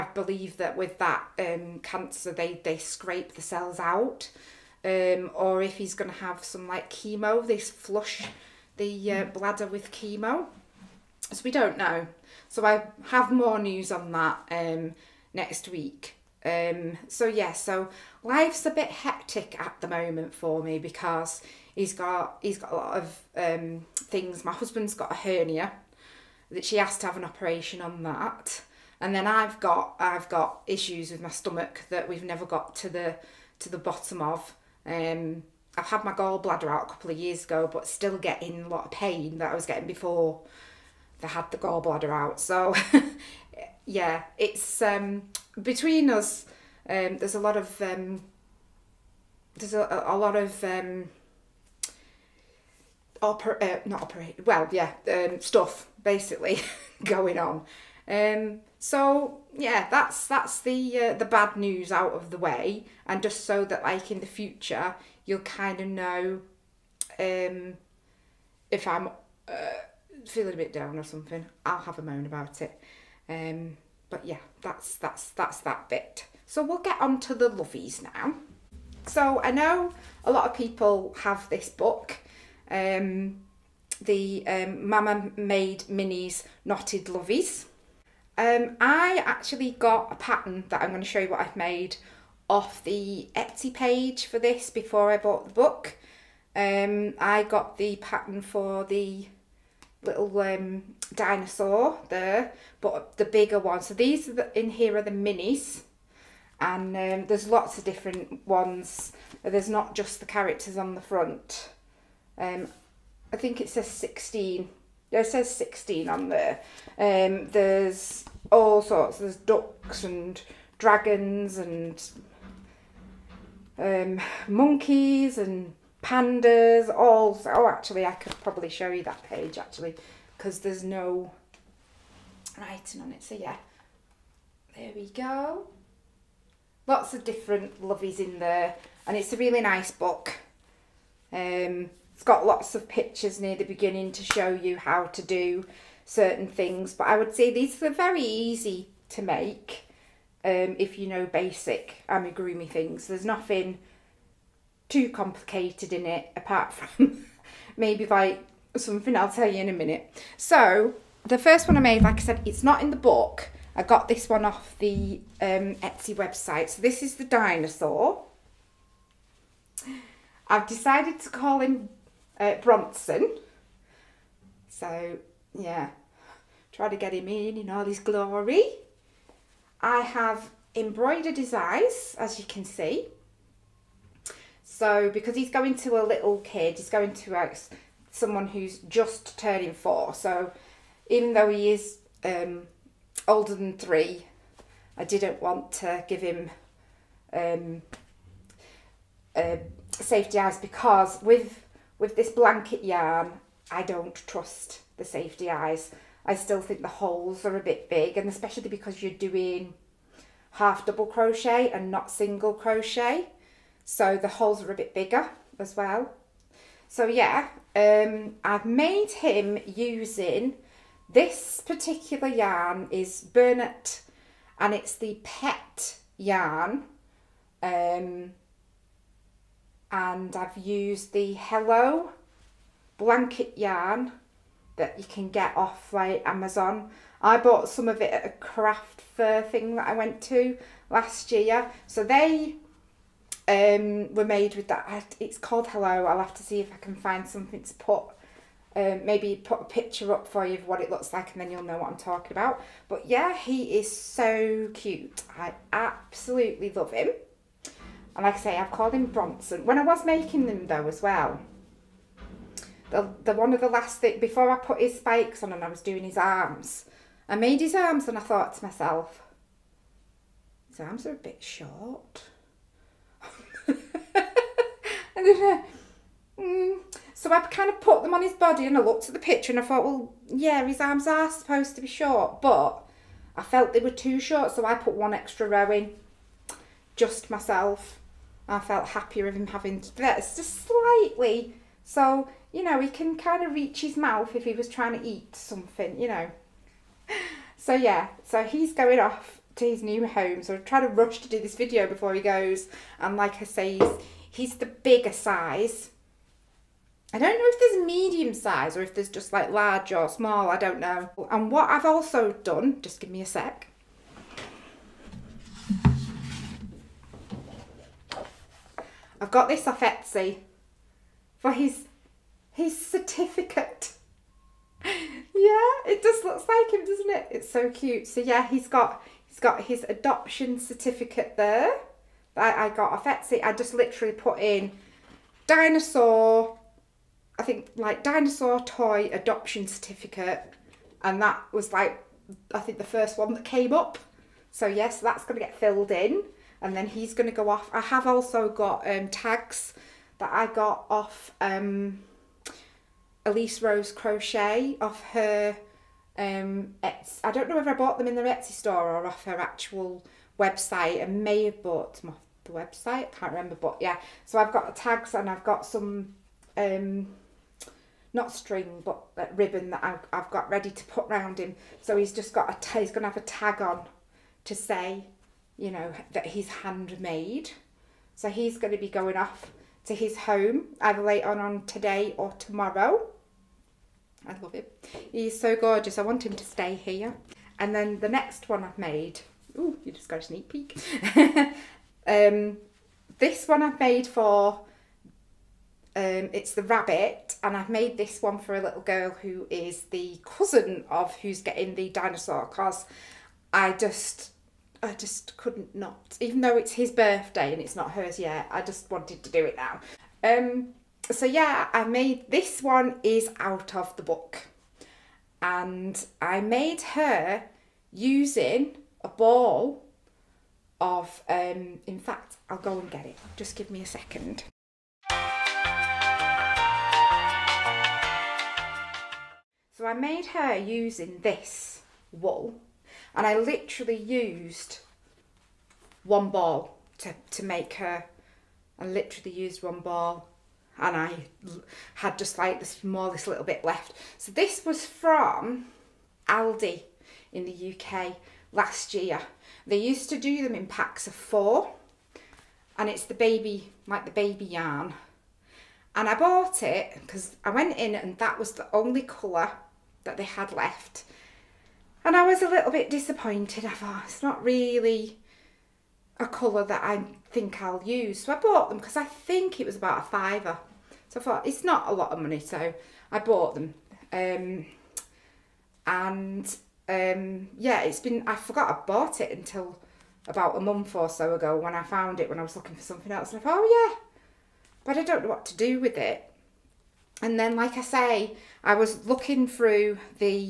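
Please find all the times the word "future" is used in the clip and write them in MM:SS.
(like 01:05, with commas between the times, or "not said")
01:04.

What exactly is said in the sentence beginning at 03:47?
Um, and I've used the Hello blanket yarn that you can get off like Amazon.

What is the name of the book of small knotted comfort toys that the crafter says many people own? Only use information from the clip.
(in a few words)
Mama Made Minis.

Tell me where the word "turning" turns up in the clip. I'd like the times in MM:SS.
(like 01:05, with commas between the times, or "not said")
03:09.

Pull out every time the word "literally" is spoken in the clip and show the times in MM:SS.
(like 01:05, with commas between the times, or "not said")
05:33, 07:13, 07:18.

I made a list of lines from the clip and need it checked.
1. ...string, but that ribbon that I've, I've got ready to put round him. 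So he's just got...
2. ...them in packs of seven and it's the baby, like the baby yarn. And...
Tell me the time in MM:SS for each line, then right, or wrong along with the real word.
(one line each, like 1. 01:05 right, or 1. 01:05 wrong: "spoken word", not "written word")
1. 06:08 right
2. 07:30 wrong: "four", not "seven".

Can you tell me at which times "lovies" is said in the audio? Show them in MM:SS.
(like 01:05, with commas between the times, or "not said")
01:17, 01:27, 02:17.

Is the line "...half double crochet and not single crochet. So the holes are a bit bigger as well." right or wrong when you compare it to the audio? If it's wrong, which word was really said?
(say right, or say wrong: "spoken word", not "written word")
right.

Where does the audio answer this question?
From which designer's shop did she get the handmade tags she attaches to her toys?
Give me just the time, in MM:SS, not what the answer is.
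05:53.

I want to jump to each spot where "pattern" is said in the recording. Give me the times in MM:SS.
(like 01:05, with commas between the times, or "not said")
01:30, 01:37.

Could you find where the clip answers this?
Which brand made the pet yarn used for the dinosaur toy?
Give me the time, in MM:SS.
03:43.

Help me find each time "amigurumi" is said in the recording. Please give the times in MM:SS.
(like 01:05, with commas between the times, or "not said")
02:32.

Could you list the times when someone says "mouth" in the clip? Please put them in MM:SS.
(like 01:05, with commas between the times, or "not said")
04:53.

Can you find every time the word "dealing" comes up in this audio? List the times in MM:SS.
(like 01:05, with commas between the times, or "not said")
not said.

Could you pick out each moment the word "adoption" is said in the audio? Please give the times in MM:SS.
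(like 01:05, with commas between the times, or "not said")
05:29, 05:39.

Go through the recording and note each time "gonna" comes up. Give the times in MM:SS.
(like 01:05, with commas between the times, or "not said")
05:45.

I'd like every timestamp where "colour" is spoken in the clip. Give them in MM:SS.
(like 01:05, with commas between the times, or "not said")
07:39, 07:46.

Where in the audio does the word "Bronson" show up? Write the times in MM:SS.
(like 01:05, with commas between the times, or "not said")
02:52, 04:19.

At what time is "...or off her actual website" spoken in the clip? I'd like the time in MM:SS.
05:58.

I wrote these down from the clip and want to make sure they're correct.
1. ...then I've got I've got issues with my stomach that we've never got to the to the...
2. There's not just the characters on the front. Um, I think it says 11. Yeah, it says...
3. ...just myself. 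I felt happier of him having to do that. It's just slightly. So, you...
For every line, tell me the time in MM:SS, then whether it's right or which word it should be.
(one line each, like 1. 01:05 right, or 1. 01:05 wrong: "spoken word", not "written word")
1. 00:29 right
2. 01:49 wrong: "16", not "11"
3. 04:46 right.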